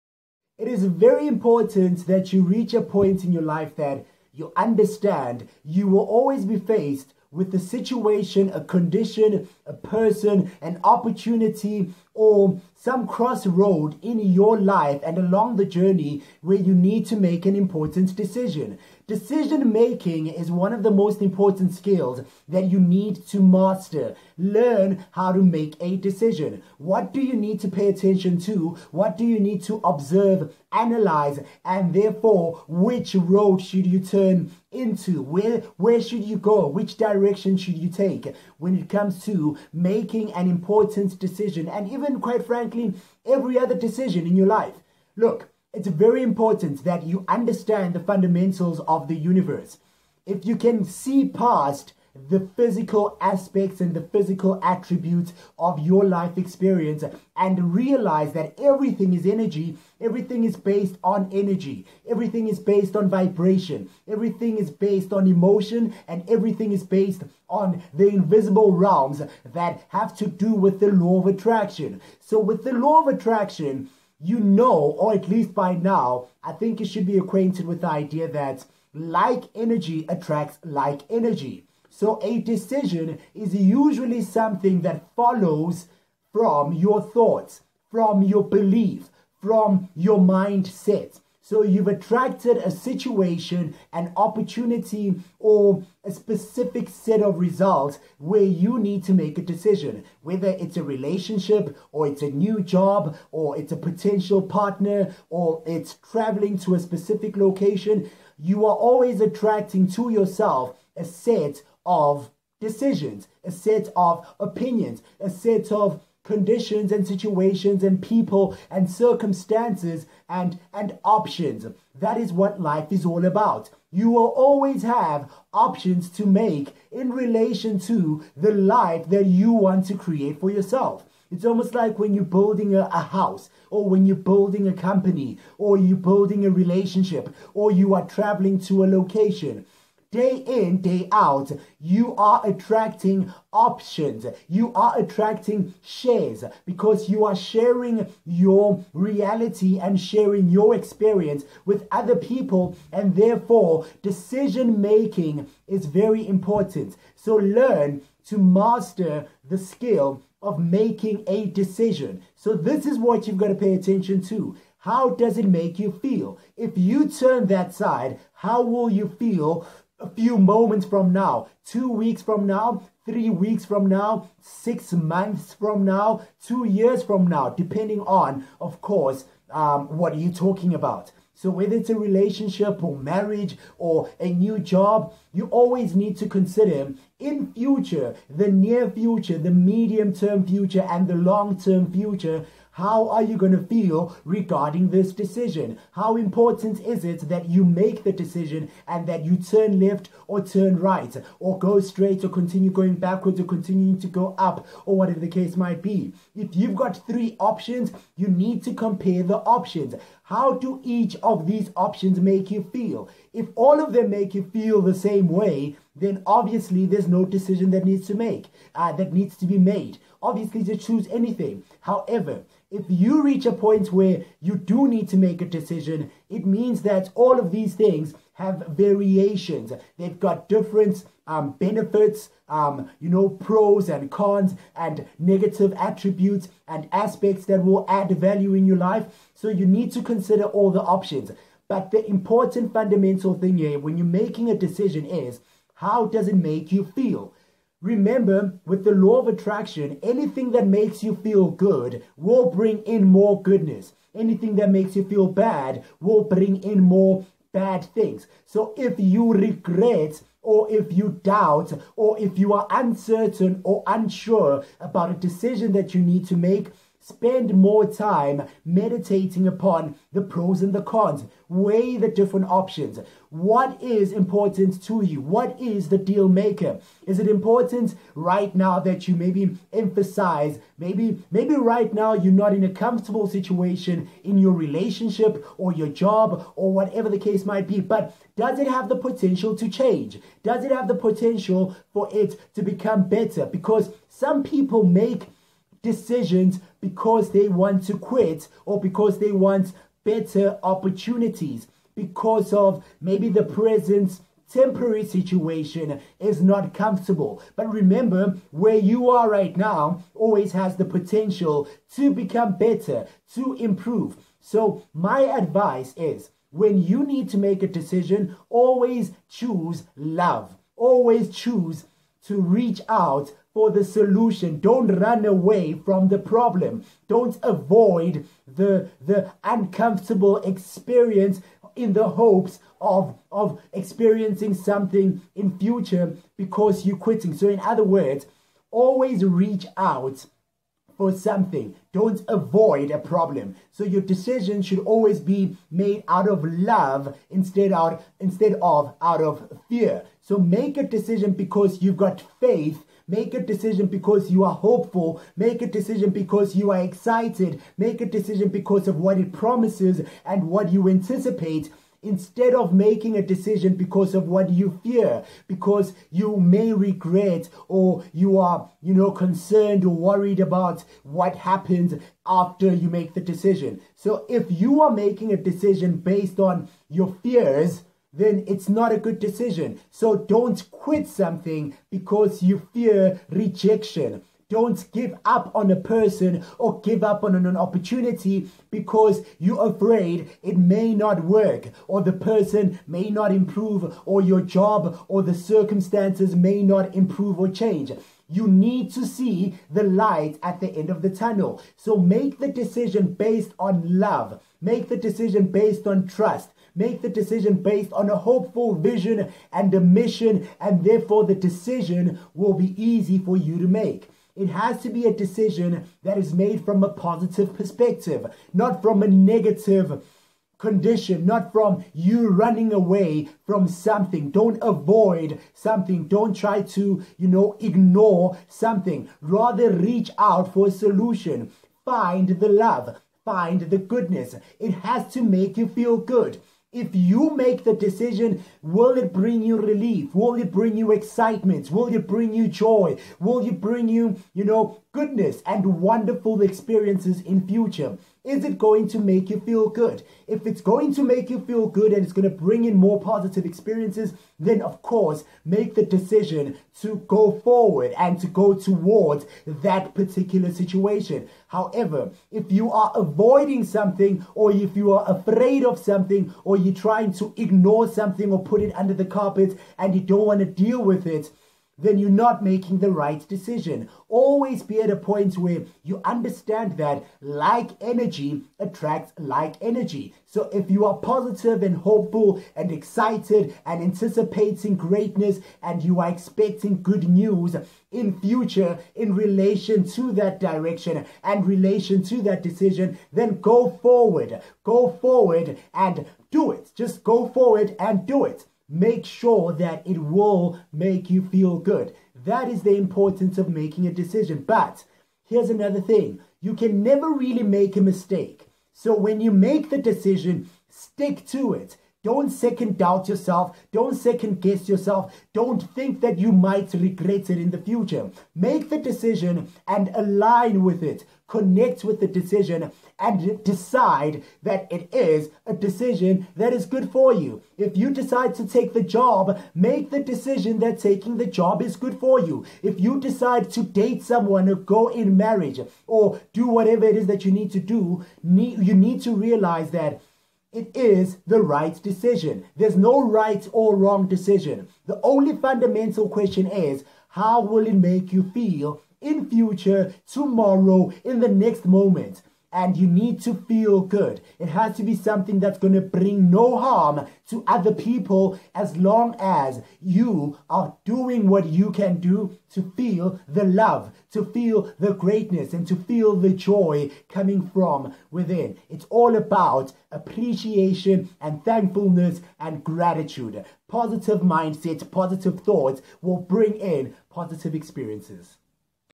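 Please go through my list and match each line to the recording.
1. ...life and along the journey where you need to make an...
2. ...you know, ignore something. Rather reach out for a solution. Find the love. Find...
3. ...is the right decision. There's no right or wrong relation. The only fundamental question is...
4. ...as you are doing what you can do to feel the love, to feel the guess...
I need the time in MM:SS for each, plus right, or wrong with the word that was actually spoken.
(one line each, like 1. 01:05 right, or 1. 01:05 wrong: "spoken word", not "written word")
1. 00:14 right
2. 07:07 right
3. 09:00 wrong: "decision", not "relation"
4. 09:19 wrong: "greatness", not "guess".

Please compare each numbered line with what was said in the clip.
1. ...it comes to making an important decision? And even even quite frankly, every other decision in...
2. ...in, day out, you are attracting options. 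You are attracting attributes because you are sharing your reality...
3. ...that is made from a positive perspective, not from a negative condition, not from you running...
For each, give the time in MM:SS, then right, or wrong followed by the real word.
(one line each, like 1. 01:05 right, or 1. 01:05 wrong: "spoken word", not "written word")
1. 00:38 right
2. 02:20 wrong: "shares", not "attributes"
3. 06:56 right.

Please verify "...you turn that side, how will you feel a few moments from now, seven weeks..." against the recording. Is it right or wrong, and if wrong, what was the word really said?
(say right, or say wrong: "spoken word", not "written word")
wrong: "two", not "seven".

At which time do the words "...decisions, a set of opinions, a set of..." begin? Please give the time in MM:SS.
01:52.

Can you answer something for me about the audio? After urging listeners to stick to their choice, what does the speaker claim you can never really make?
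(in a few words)
a mistake.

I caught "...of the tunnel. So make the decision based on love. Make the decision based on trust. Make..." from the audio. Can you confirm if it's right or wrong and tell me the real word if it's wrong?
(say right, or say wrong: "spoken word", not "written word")
right.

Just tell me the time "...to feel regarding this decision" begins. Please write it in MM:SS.
03:13.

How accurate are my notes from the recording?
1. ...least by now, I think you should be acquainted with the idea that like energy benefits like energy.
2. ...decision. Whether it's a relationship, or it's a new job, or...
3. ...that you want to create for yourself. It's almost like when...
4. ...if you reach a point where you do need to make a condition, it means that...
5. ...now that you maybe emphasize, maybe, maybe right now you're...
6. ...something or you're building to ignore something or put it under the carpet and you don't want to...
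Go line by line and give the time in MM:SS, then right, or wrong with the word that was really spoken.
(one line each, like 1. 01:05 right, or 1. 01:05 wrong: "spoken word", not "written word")
1. 01:15 wrong: "attracts", not "benefits"
2. 01:39 right
3. 02:09 right
4. 03:42 wrong: "decision", not "condition"
5. 04:38 right
6. 07:45 wrong: "trying", not "building".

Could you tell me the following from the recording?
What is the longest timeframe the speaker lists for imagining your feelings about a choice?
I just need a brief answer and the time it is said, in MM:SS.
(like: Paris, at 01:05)
two years, at 02:56.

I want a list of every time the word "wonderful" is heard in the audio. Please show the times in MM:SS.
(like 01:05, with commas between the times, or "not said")
07:25.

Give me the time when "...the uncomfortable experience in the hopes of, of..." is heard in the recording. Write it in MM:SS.
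05:29.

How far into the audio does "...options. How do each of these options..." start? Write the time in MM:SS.
03:29.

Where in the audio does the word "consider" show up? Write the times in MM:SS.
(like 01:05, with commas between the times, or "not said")
03:06, 04:00.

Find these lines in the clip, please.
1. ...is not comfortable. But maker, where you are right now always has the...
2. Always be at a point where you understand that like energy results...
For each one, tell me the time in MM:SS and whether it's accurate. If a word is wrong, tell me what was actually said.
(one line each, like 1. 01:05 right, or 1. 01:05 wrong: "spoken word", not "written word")
1. 05:06 wrong: "remember", not "maker"
2. 07:54 wrong: "attracts", not "results".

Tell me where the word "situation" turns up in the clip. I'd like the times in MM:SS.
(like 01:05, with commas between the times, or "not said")
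00:07, 01:32, 01:57, 04:43, 05:05, 07:40.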